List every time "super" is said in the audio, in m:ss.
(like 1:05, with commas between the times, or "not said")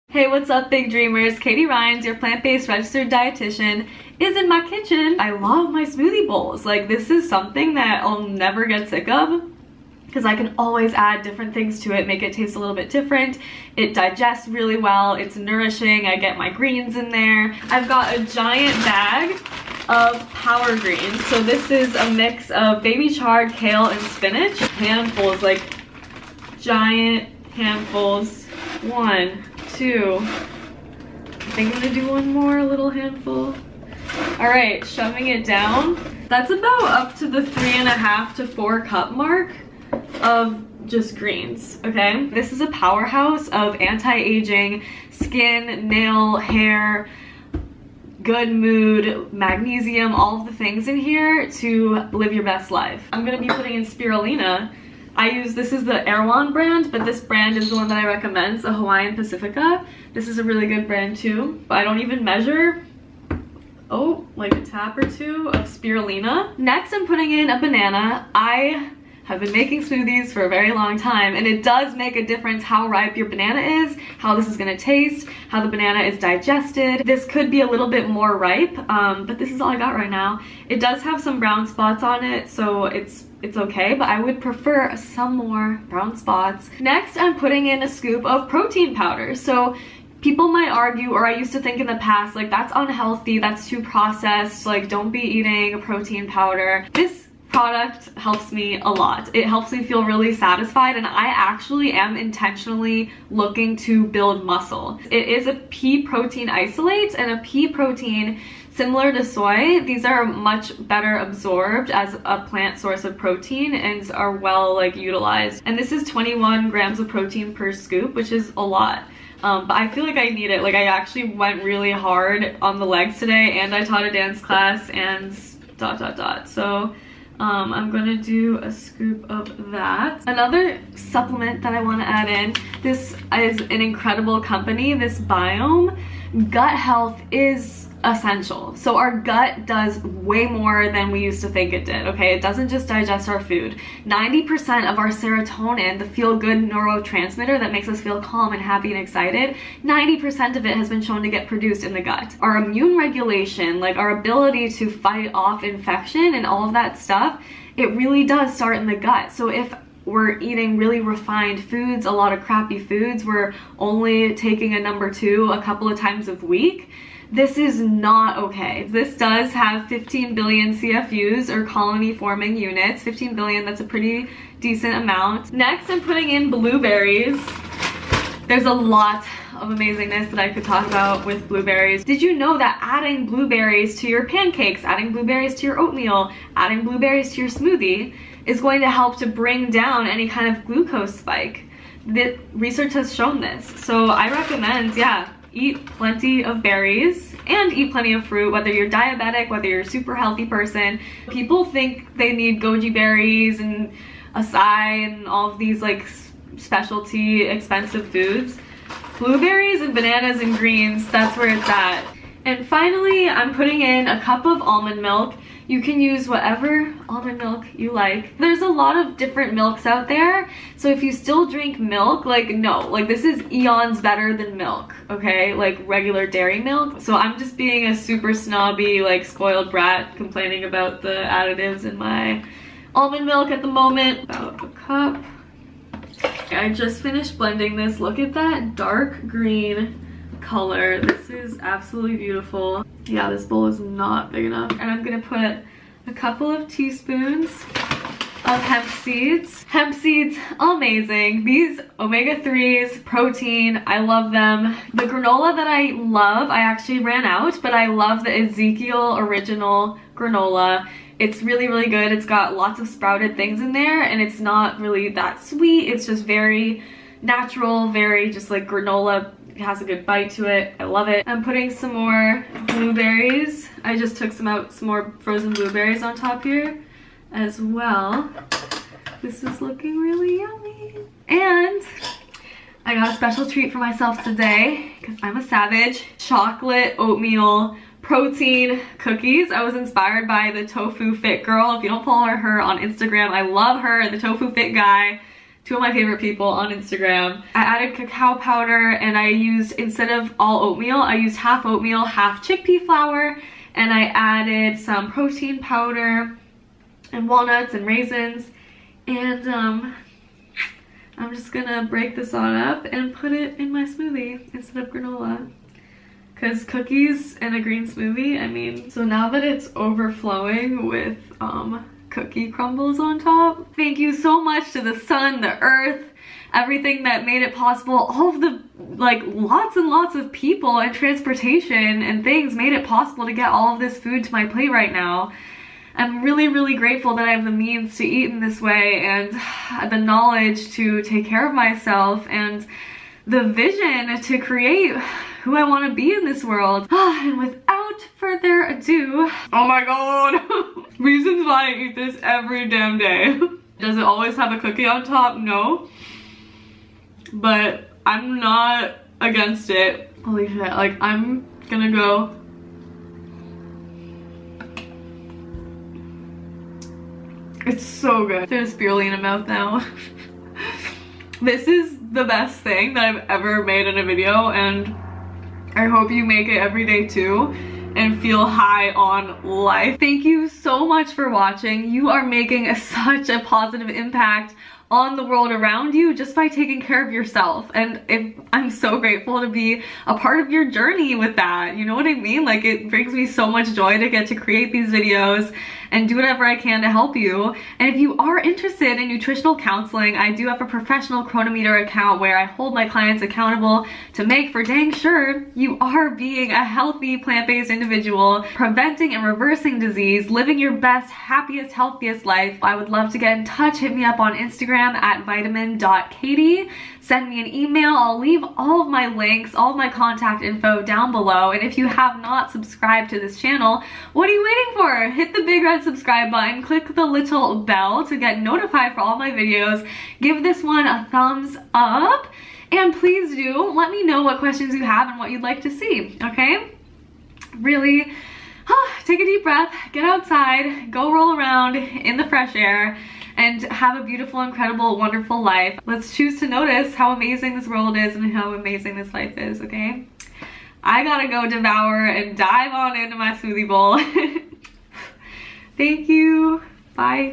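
3:19, 3:47.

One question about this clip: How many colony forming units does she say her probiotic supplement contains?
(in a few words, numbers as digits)
15 billion.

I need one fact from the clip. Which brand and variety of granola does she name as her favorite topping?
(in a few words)
Ezekiel original.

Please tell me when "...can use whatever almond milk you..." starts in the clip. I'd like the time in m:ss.
3:35.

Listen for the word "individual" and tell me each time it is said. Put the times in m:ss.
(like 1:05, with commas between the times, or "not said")
6:47.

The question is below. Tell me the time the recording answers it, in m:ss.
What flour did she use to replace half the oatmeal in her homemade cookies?
5:02.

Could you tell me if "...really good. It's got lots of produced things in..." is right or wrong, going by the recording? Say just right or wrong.
wrong.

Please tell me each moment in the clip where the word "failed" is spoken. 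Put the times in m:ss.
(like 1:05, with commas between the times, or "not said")
not said.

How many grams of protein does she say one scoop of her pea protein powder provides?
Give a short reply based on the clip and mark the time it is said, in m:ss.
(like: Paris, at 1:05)
21, at 1:56.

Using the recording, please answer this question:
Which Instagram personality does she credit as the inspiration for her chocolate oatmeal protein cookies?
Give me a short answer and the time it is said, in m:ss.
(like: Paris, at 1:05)
Tofu Fit Girl, at 4:50.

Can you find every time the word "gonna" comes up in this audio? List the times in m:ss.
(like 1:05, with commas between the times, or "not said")
0:31, 0:53, 1:14, 2:07, 4:05, 5:11, 6:01.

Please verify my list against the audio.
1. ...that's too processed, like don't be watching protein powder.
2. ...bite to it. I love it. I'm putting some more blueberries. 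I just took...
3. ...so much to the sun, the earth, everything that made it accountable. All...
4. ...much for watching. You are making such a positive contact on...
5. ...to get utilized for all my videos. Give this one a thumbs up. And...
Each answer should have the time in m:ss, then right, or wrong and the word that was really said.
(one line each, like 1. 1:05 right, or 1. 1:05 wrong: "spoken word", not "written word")
1. 1:33 wrong: "eating", not "watching"
2. 4:30 right
3. 5:24 wrong: "possible", not "accountable"
4. 6:20 wrong: "impact", not "contact"
5. 7:08 wrong: "notified", not "utilized".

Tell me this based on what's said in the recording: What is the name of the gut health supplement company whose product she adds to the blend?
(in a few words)
Biohm.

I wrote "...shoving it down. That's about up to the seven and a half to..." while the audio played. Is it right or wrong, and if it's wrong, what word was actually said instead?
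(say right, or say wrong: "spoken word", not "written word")
wrong: "three", not "seven".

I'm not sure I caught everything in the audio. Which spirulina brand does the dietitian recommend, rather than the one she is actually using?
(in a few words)
Hawaiian Pacifica.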